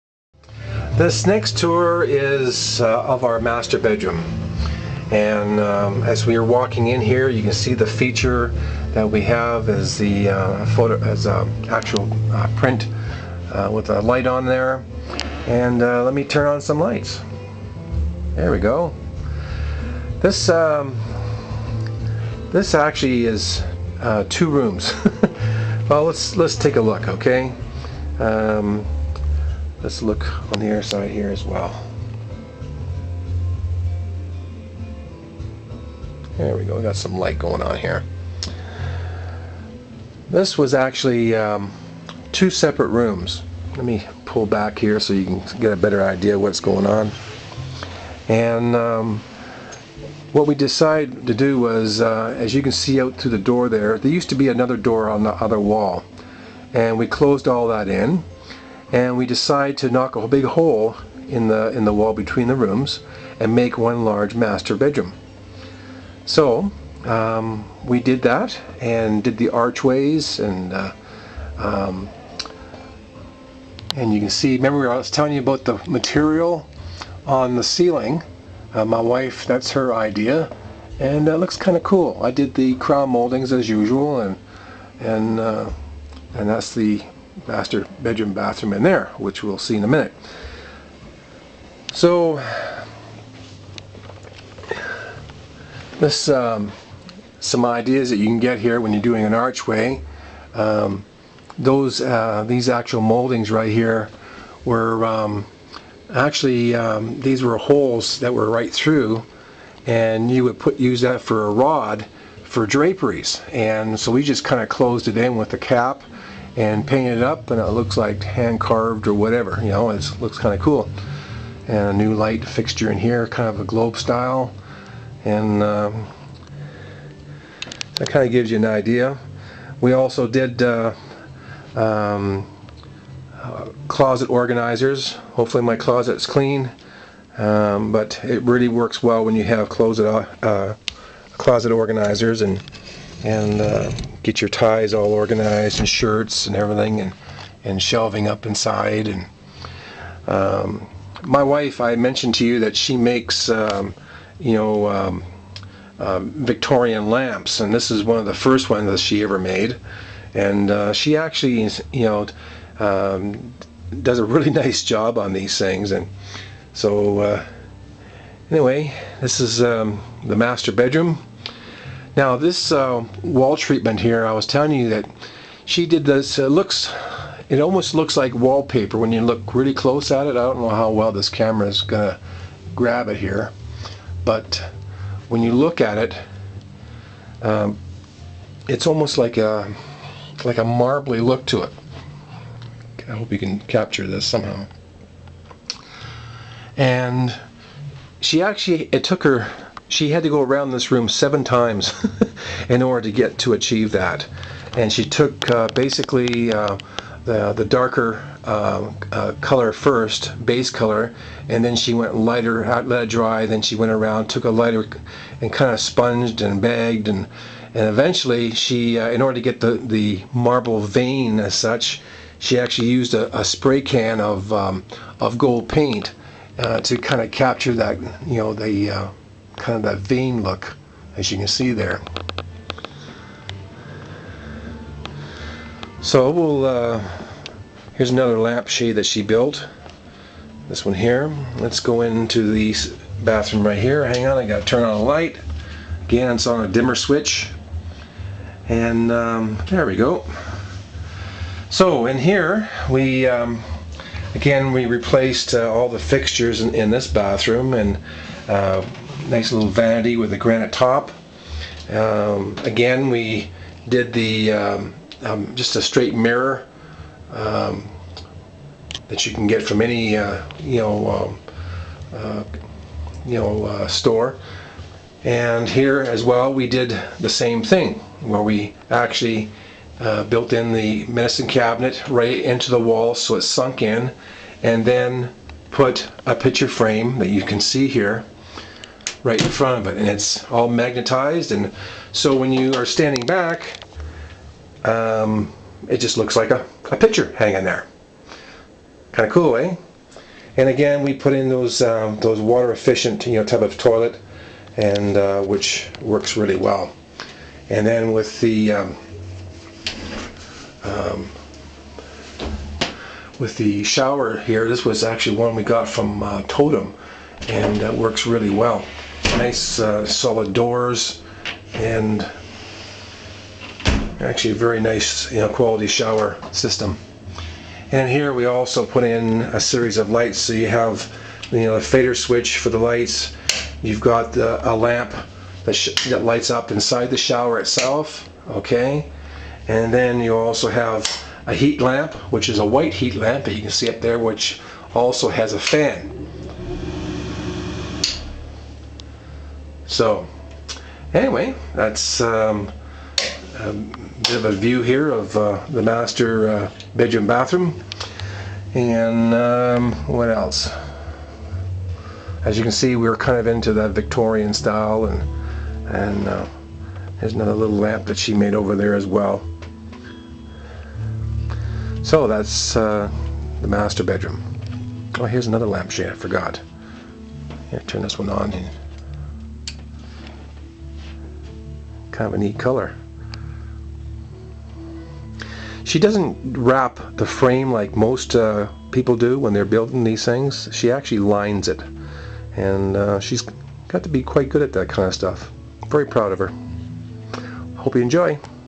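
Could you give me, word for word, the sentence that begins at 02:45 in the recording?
And so, uh, anyway, this is um, the master bedroom.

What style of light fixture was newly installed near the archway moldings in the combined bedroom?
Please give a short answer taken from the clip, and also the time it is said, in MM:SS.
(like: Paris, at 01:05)
globe style, at 02:03.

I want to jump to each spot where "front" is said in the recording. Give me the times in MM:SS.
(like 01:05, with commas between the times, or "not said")
04:49.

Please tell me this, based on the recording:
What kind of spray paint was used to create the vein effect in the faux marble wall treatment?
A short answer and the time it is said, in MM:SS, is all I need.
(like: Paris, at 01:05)
gold paint, at 03:45.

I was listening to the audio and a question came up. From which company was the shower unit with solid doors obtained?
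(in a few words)
Totem.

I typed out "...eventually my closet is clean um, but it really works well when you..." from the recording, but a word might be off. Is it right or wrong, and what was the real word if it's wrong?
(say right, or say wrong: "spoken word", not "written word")
wrong: "hopefully", not "eventually".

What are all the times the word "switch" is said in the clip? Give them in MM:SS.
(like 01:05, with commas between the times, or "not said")
04:06, 05:32.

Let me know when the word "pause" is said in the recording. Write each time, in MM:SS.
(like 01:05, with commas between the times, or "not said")
not said.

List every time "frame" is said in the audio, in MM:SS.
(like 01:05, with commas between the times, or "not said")
04:46, 06:27.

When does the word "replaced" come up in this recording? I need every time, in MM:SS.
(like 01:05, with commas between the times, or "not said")
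04:14.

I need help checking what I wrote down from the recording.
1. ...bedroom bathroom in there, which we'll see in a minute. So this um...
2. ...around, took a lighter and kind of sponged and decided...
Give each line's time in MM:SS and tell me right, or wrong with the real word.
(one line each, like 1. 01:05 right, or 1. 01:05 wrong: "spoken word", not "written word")
1. 01:28 right
2. 03:33 wrong: "bagged", not "decided".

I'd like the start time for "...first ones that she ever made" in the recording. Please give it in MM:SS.
02:38.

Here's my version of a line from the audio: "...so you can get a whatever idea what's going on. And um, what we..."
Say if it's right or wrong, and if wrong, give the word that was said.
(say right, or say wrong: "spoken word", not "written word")
wrong: "better", not "whatever".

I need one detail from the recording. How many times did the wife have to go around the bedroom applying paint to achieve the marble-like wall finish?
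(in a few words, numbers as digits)
7.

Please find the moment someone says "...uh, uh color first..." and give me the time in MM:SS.
03:28.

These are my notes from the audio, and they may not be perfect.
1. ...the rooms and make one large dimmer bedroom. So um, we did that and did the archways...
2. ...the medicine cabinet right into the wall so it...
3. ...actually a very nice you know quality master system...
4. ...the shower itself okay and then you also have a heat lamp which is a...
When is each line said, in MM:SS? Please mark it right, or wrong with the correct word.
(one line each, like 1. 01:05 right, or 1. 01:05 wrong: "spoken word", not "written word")
1. 01:02 wrong: "master", not "dimmer"
2. 04:40 right
3. 05:24 wrong: "shower", not "master"
4. 05:37 right.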